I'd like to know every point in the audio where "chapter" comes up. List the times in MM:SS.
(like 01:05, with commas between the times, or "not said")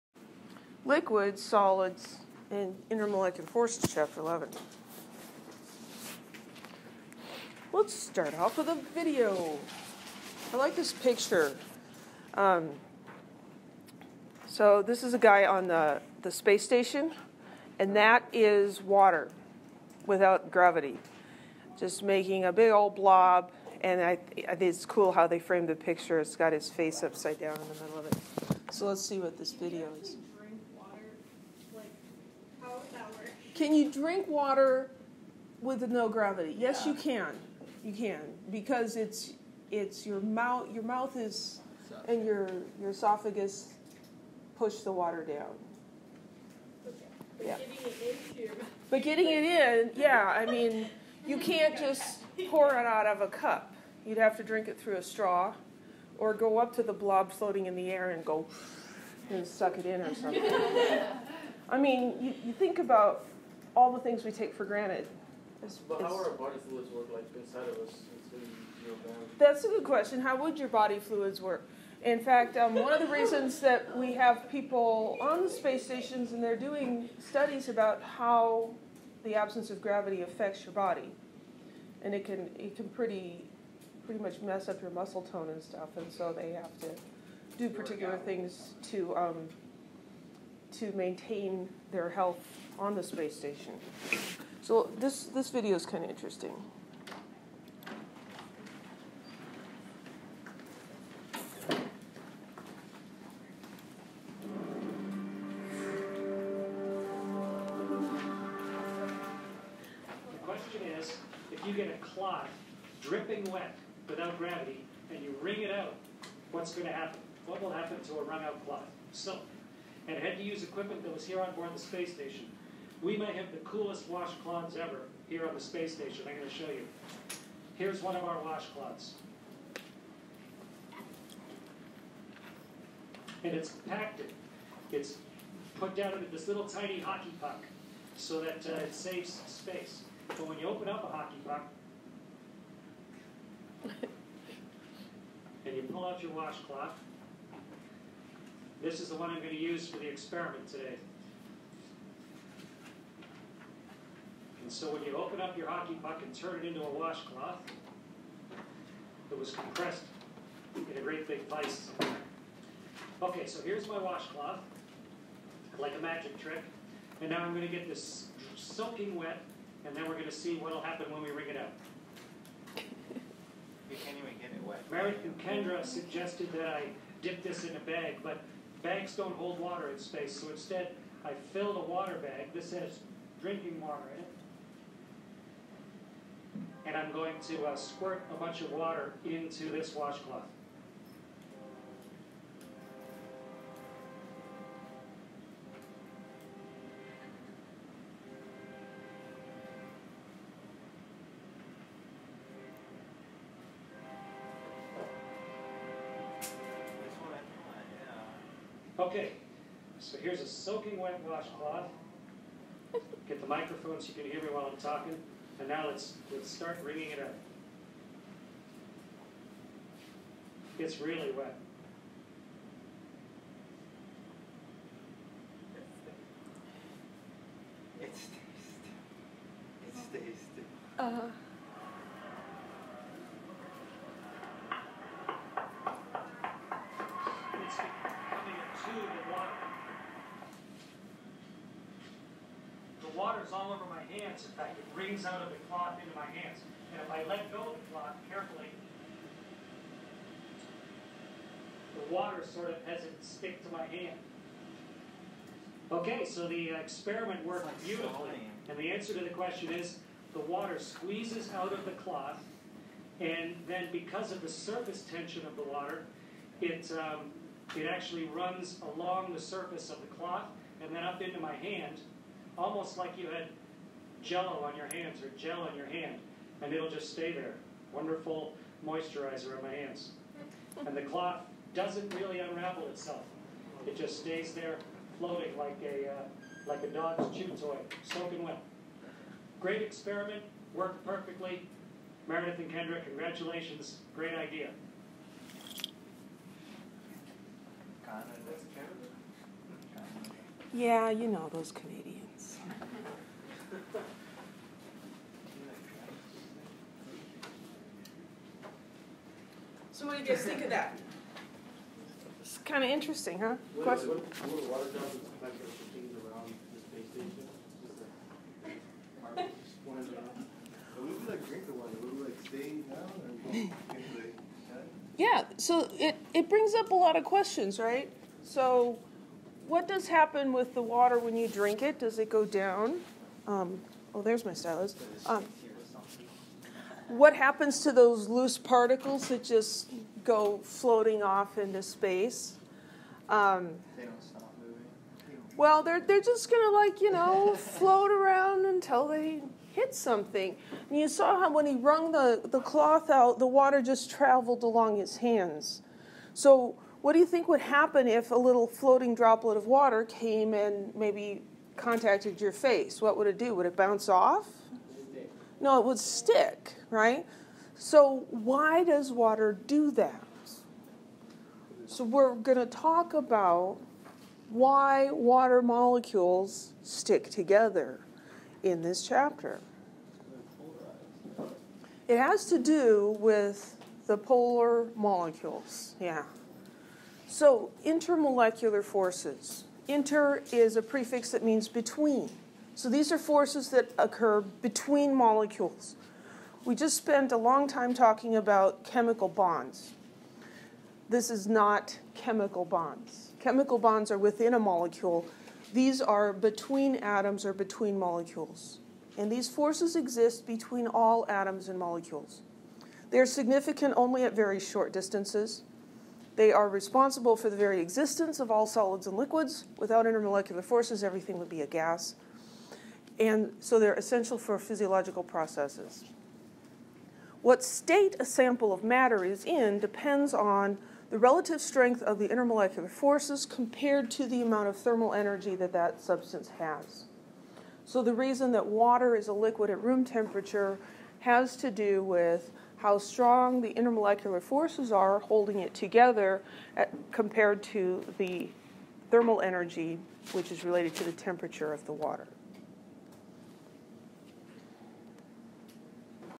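00:03, 06:19.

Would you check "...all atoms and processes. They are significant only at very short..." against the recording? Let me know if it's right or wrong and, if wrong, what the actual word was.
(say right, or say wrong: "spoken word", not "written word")
wrong: "molecules", not "processes".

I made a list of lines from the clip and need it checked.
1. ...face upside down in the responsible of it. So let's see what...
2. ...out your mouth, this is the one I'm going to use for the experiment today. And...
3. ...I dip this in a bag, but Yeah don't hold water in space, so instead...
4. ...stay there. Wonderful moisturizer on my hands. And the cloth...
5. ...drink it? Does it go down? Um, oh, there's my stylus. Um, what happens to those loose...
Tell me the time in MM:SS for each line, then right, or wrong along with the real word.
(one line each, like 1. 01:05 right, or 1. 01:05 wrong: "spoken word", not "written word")
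1. 00:26 wrong: "middle", not "responsible"
2. 02:26 wrong: "washcloth", not "mouth"
3. 02:56 wrong: "Bags", not "Yeah"
4. 04:37 right
5. 05:31 right.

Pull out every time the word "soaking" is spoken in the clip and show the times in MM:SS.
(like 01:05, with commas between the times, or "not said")
02:48, 03:30, 04:48.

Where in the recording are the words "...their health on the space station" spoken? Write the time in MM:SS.
01:31.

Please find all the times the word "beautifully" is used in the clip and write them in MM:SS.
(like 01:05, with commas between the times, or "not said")
04:17.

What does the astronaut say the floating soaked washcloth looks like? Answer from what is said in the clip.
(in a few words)
a dog's chew toy.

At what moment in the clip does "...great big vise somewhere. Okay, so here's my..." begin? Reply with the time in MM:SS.
02:41.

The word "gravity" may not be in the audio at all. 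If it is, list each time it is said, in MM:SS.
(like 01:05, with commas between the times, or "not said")
00:20, 00:36, 01:19, 01:54.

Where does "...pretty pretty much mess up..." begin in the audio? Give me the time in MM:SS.
01:22.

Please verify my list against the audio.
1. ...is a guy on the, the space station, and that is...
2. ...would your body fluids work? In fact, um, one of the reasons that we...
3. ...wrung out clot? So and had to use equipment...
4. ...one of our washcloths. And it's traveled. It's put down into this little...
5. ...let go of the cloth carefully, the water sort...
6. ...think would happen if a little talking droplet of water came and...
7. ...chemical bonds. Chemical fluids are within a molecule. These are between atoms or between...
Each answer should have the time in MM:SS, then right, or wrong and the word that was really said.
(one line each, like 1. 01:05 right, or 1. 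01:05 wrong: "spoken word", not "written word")
1. 00:15 right
2. 01:10 right
3. 01:58 right
4. 02:08 wrong: "compacted", not "traveled"
5. 04:07 right
6. 05:57 wrong: "floating", not "talking"
7. 06:42 wrong: "bonds", not "fluids".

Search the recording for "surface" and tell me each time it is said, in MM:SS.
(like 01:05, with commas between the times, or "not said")
04:24, 04:29.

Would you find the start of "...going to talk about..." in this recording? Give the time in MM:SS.
06:12.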